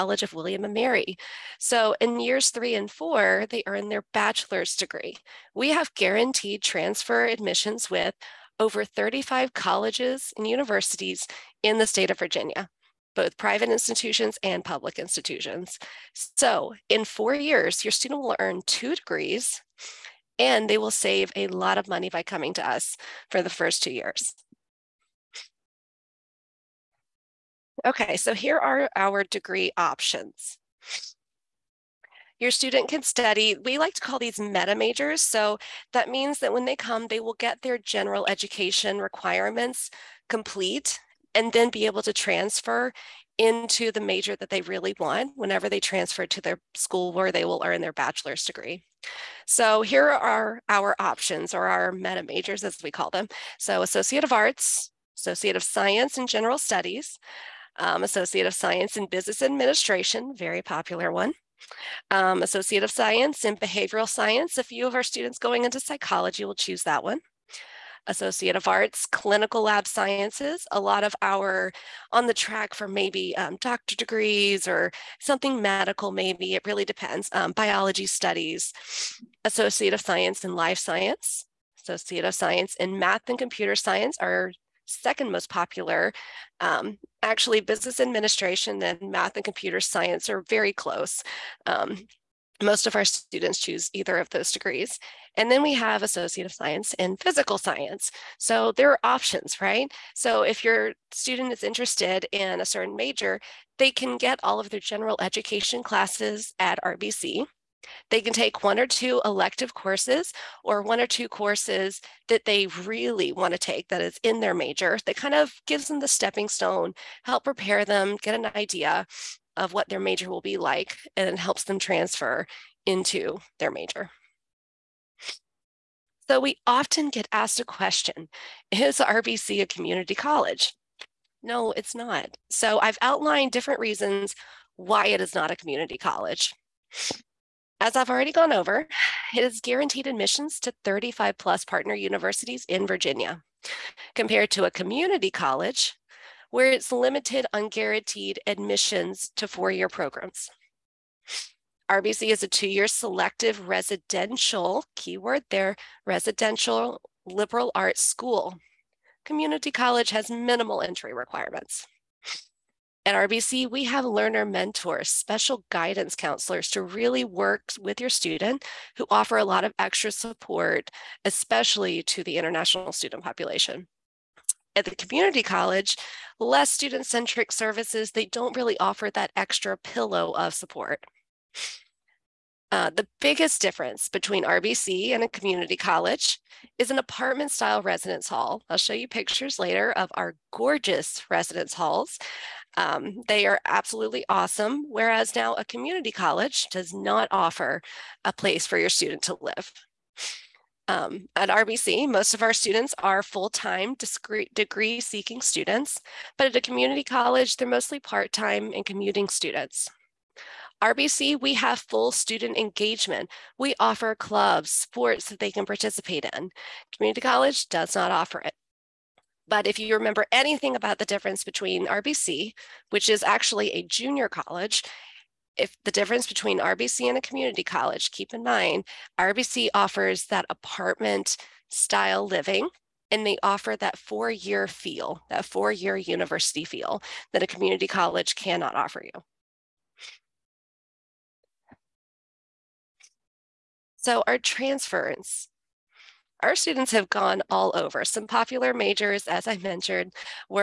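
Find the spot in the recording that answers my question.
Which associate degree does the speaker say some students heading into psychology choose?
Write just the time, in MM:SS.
01:02.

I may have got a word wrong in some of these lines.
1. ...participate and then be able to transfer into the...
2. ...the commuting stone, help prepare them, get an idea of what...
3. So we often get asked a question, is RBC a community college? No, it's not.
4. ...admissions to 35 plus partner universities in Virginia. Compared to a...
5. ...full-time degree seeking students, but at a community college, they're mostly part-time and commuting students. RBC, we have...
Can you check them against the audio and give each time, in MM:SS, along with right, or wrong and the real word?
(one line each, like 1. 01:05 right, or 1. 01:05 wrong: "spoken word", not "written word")
1. 00:40 wrong: "complete", not "participate"
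2. 01:55 wrong: "stepping", not "commuting"
3. 02:06 right
4. 02:20 right
5. 03:23 right.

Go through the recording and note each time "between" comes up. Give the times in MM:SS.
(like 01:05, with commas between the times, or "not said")
03:04, 03:41, 03:46.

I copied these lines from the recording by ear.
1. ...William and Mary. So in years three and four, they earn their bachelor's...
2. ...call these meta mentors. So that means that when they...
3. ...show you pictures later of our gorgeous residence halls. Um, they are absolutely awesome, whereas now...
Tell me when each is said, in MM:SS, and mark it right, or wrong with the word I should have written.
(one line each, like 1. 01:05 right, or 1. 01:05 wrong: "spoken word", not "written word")
1. 00:00 right
2. 00:34 wrong: "majors", not "mentors"
3. 03:08 right.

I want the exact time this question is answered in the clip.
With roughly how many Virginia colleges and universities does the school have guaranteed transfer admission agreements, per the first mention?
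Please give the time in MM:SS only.
00:08.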